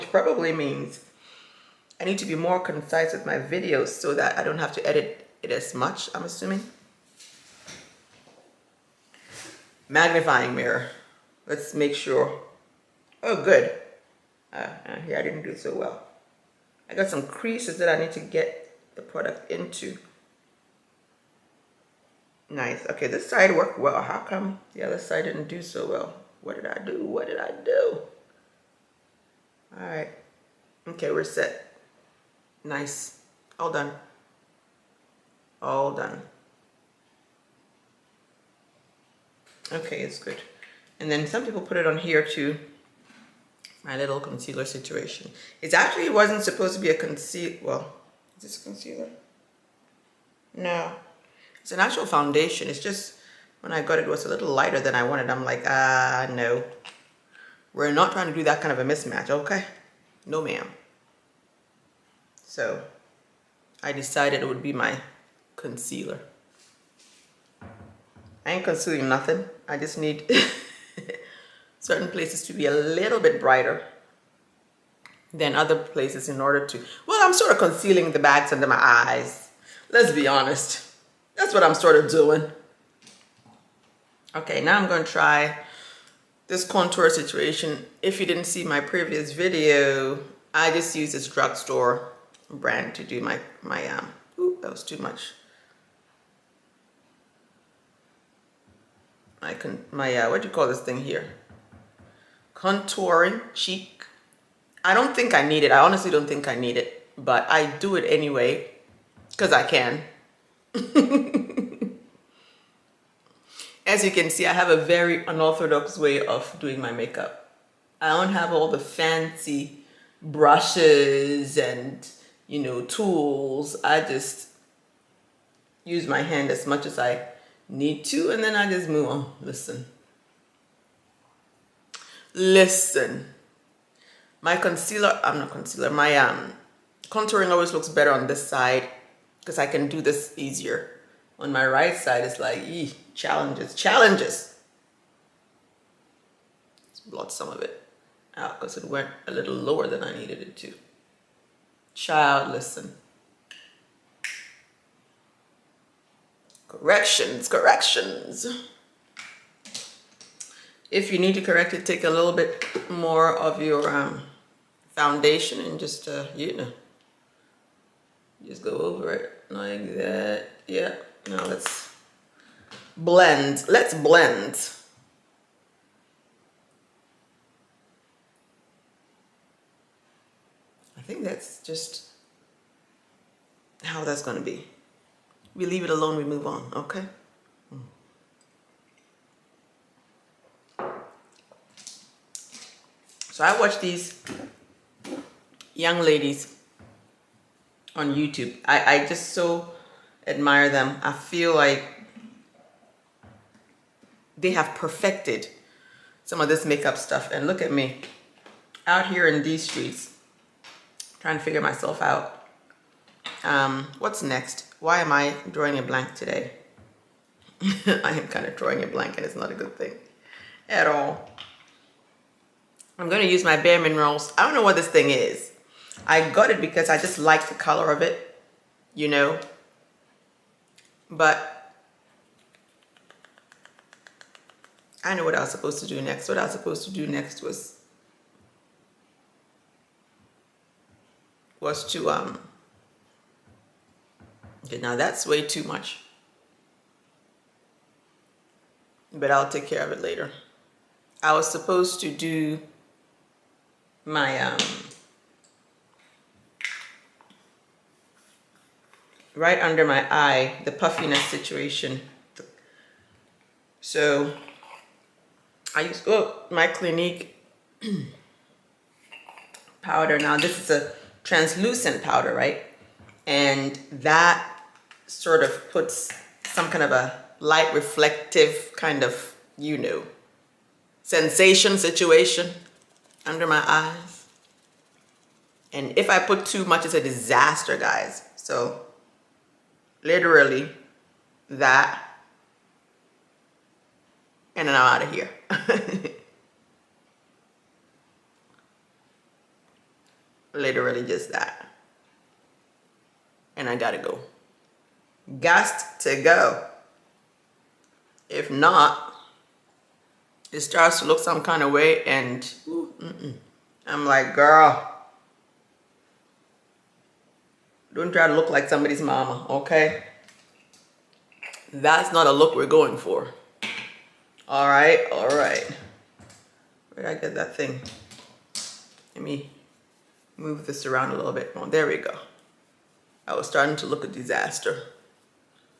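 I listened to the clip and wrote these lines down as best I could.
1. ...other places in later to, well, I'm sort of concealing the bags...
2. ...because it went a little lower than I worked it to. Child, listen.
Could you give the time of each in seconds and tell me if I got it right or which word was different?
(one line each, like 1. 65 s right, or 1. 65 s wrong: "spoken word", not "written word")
1. 75 s wrong: "order", not "later"
2. 148 s wrong: "needed", not "worked".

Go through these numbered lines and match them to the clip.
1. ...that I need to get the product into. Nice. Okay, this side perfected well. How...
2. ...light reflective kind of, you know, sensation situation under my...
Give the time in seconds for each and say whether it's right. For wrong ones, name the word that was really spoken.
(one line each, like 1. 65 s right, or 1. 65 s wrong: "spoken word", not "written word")
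1. 17 s wrong: "worked", not "perfected"
2. 277 s right.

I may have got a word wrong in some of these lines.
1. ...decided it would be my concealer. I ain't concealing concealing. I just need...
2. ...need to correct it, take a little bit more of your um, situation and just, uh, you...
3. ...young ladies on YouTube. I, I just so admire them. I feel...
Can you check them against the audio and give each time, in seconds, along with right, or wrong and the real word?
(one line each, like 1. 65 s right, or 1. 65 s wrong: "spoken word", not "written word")
1. 63 s wrong: "nothing", not "concealing"
2. 161 s wrong: "foundation", not "situation"
3. 195 s right.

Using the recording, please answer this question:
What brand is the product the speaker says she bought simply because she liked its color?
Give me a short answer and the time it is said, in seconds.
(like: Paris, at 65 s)
Bare Minerals, at 223 s.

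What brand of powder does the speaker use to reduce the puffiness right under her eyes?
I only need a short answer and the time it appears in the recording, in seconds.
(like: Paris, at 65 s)
Clinique, at 266 s.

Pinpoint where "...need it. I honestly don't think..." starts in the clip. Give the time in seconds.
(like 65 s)
105 s.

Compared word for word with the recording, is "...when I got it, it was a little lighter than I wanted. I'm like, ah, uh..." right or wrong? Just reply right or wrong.
right.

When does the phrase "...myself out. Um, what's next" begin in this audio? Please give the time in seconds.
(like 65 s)
211 s.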